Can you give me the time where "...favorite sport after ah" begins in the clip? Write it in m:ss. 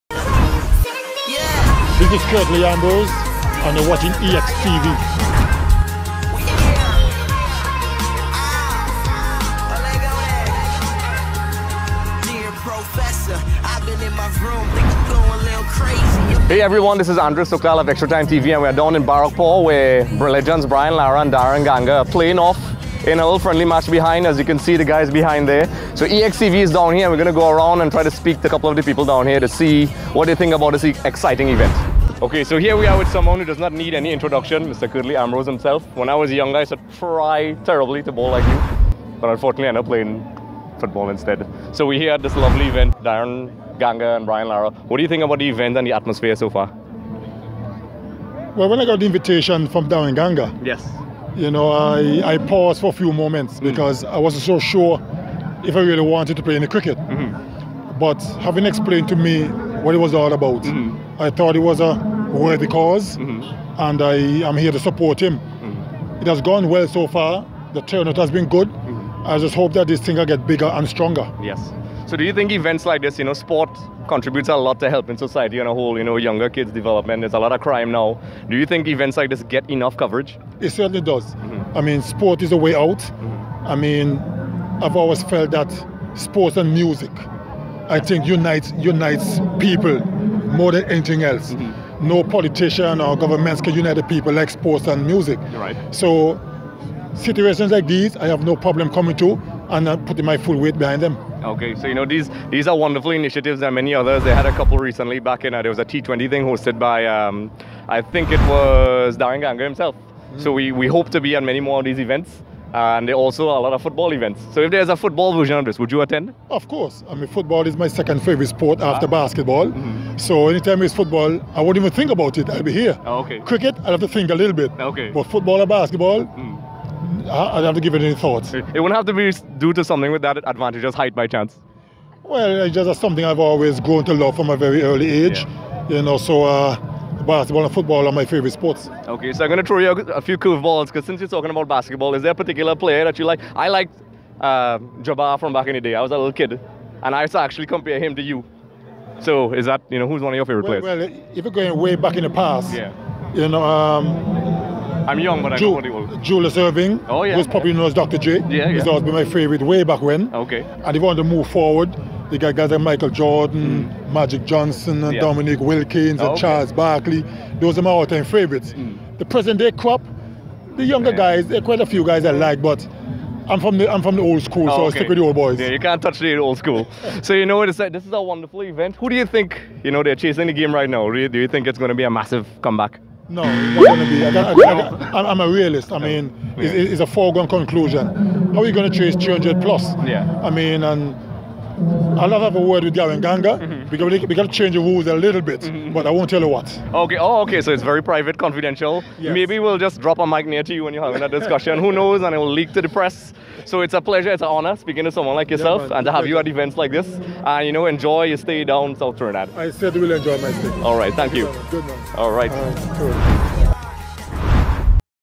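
1:58.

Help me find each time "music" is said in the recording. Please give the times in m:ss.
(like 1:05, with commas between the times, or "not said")
1:26, 1:35.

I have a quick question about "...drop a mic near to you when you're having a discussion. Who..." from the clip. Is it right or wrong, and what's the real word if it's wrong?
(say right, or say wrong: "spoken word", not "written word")
right.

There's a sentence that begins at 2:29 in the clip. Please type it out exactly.
So is that you know who's one of your favorite well, players?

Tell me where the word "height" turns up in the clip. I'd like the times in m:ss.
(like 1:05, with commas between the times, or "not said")
2:10.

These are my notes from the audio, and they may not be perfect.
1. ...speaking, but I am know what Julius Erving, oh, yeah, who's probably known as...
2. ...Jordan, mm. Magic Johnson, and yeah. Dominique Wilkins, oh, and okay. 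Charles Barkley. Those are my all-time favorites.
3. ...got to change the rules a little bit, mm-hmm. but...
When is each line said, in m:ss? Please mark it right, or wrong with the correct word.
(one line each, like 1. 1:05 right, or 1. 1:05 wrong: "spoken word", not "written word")
1. 2:35 wrong: "young", not "speaking"
2. 2:43 right
3. 3:14 right.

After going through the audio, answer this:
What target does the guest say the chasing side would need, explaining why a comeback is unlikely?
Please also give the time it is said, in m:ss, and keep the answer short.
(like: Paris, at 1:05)
300 plus, at 3:09.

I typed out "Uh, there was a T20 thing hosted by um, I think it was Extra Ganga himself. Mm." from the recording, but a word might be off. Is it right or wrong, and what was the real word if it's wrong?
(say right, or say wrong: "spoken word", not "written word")
wrong: "Daren", not "Extra".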